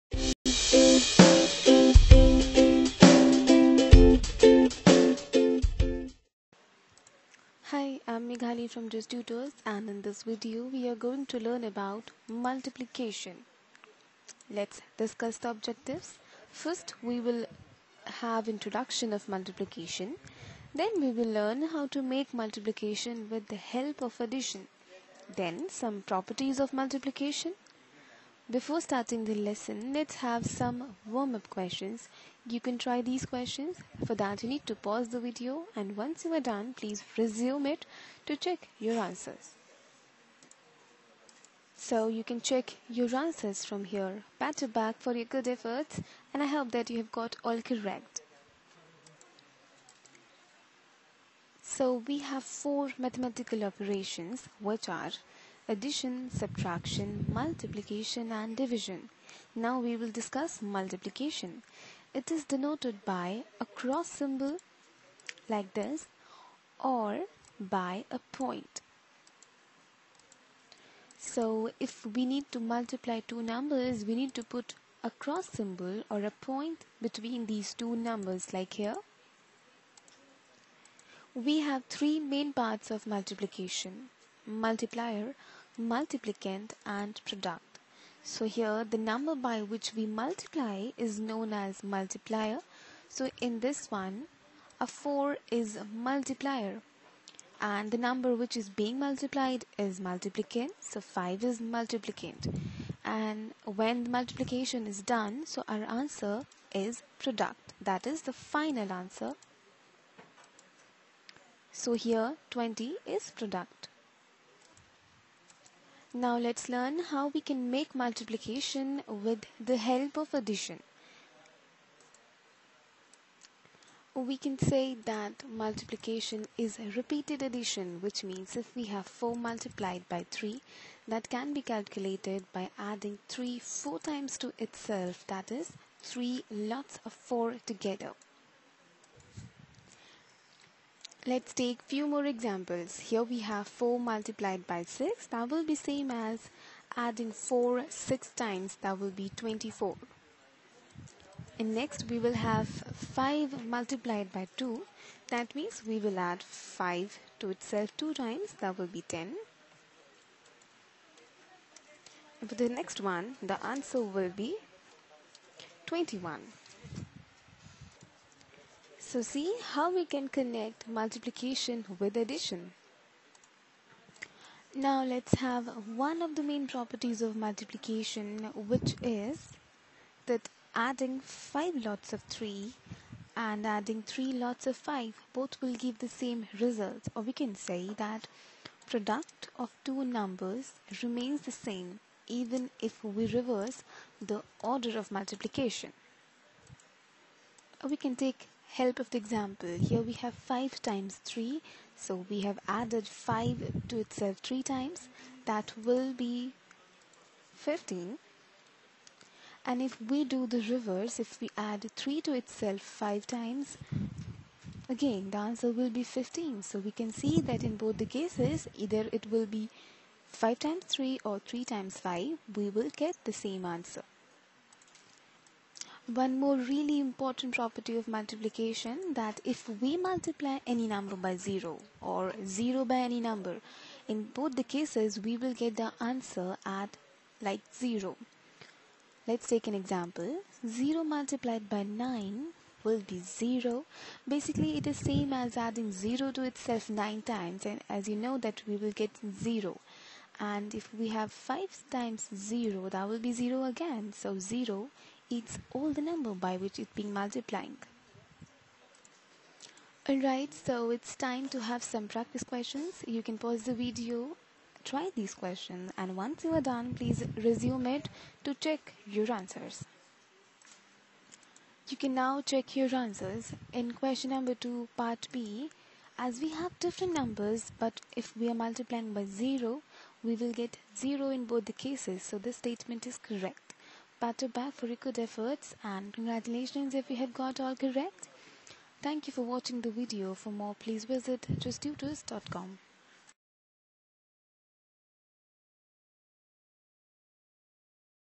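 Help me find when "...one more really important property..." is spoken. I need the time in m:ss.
3:46.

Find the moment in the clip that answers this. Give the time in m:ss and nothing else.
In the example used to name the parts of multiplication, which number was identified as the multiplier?
1:34.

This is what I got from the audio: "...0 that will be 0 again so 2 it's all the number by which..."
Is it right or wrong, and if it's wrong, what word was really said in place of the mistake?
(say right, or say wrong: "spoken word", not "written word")
wrong: "0", not "2".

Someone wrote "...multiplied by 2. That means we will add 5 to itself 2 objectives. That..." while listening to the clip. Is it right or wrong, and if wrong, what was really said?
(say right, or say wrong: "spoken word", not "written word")
wrong: "times", not "objectives".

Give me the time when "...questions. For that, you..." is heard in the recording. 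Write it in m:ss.
0:33.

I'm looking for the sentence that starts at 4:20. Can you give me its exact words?
Alright, so it's time to have some practice questions.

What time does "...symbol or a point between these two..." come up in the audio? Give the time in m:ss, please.
1:15.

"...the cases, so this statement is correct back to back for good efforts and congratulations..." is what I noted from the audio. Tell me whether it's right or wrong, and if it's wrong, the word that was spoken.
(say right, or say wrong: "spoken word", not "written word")
right.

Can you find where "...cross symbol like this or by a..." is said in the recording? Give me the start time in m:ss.
1:03.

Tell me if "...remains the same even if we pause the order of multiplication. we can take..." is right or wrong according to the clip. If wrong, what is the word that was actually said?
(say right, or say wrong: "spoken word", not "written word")
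wrong: "reverse", not "pause".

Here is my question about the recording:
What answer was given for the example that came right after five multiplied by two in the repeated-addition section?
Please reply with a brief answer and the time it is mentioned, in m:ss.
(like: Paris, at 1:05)
21, at 2:45.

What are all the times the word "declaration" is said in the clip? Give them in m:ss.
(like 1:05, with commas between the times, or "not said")
not said.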